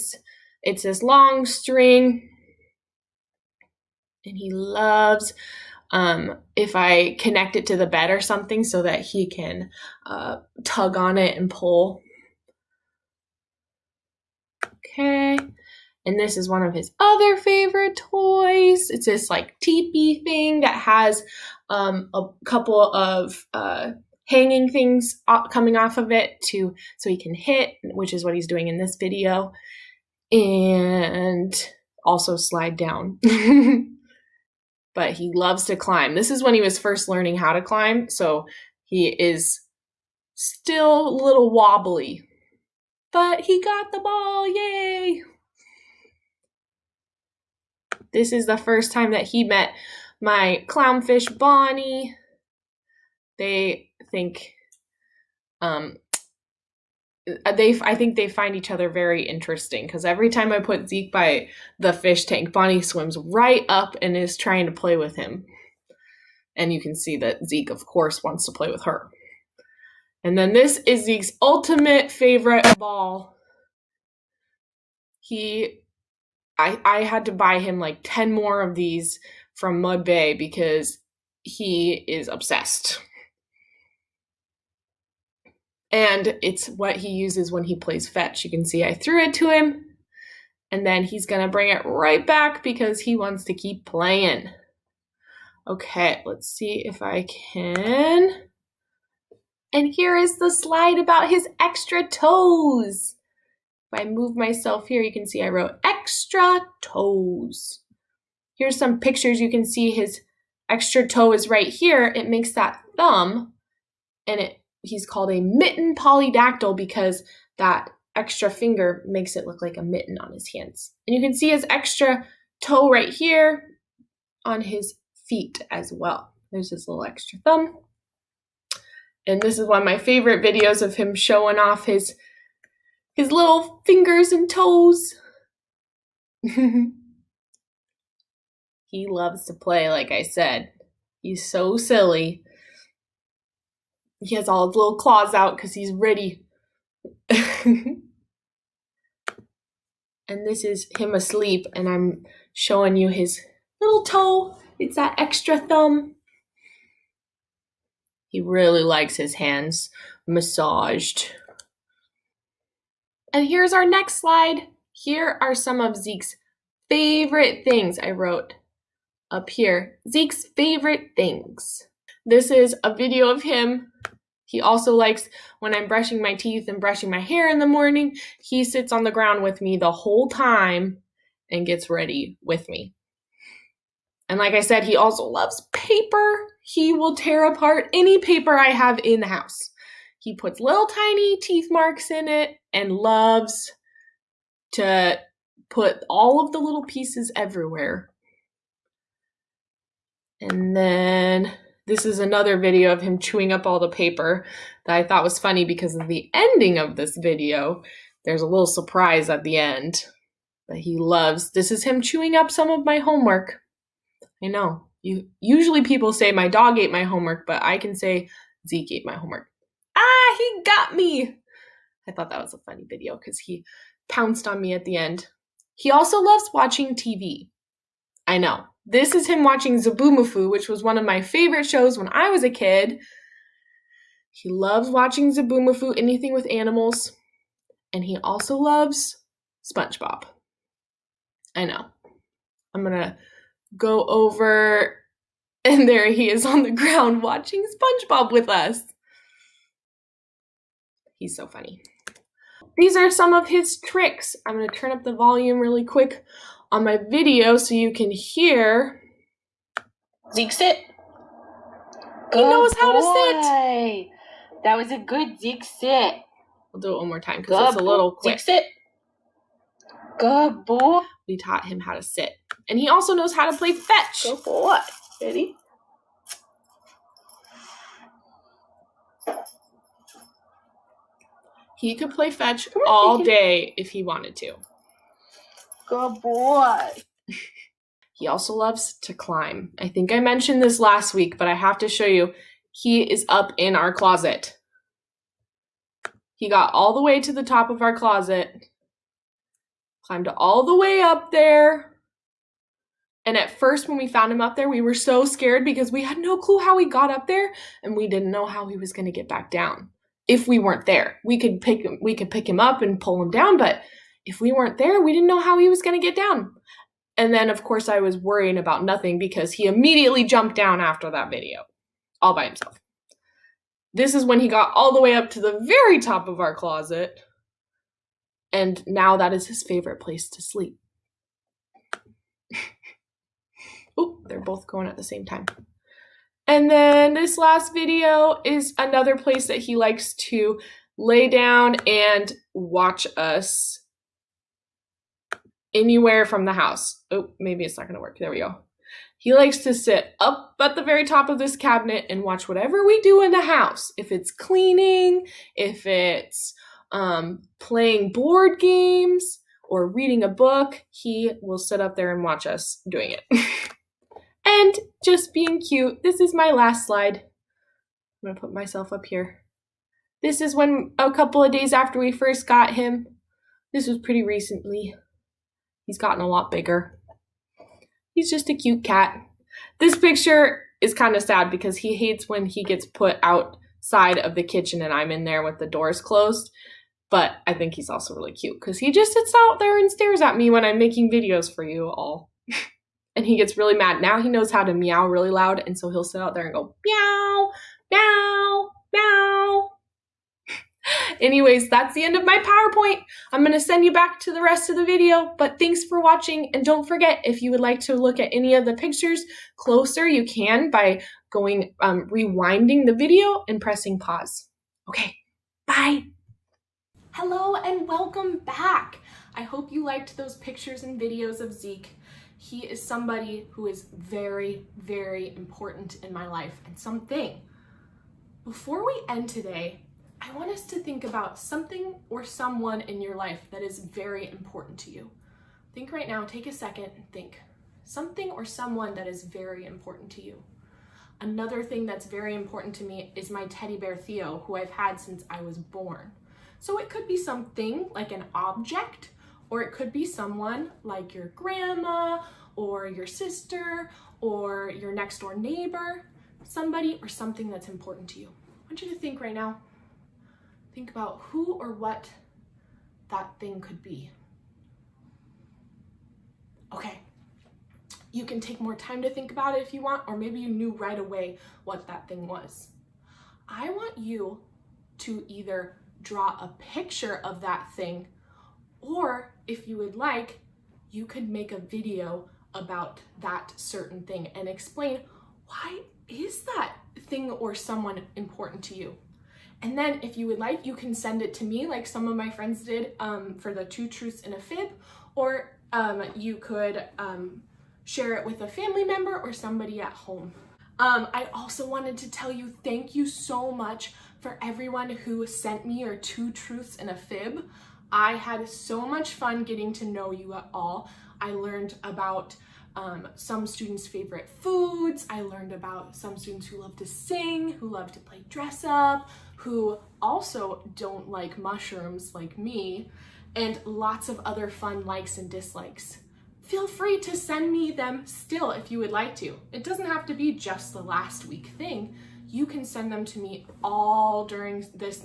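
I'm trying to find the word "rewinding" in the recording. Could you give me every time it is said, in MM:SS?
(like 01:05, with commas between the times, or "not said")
06:52.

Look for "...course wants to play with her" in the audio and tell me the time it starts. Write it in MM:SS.
01:07.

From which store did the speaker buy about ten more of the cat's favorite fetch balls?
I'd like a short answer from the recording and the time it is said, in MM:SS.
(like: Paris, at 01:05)
Mud Bay, at 01:19.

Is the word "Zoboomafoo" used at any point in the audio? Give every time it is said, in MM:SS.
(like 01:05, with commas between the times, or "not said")
03:49, 03:55.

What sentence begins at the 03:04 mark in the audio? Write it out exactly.
And like I said, he also loves paper he will tear apart any paper I have in the house.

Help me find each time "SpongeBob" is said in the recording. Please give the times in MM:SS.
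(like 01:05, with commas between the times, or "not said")
03:59, 04:08.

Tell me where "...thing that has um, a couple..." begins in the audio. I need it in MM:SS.
00:20.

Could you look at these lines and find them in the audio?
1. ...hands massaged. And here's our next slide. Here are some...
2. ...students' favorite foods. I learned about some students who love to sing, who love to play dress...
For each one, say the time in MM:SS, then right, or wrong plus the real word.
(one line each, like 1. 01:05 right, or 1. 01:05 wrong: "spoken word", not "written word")
1. 02:39 right
2. 08:33 right.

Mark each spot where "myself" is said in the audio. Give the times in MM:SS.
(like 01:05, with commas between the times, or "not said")
01:44, 06:08.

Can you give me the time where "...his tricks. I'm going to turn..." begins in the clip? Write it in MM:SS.
04:13.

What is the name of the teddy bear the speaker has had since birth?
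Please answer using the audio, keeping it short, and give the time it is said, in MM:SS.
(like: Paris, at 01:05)
Theo, at 07:23.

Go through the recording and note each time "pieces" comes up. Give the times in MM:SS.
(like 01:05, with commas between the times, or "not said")
03:16.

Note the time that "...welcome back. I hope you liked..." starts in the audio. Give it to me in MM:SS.
06:57.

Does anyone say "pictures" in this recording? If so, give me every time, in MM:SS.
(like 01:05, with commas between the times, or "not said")
01:48, 06:19, 06:48, 07:00, 07:56.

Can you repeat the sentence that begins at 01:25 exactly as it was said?
And it's what he uses when he plays fetch.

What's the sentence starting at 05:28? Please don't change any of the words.
And now that is his favorite place to sleep.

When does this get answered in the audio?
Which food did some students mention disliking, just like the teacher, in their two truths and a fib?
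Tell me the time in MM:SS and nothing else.
08:41.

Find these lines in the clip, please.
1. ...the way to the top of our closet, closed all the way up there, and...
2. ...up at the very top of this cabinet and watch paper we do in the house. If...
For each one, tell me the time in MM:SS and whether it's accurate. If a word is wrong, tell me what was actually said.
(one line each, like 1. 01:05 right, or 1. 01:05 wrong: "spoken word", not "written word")
1. 04:56 wrong: "climbed", not "closed"
2. 05:50 wrong: "whatever", not "paper".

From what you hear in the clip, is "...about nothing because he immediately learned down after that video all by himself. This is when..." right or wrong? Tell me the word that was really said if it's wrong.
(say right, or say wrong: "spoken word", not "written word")
wrong: "jumped", not "learned".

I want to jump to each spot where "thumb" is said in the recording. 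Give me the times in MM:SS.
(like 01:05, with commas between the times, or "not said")
01:52, 02:07, 02:35.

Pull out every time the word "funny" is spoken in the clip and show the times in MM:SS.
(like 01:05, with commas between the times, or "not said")
03:25, 03:42, 04:11.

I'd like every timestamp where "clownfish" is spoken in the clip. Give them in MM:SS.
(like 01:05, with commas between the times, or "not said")
00:50.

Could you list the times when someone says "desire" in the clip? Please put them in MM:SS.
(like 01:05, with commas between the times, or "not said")
not said.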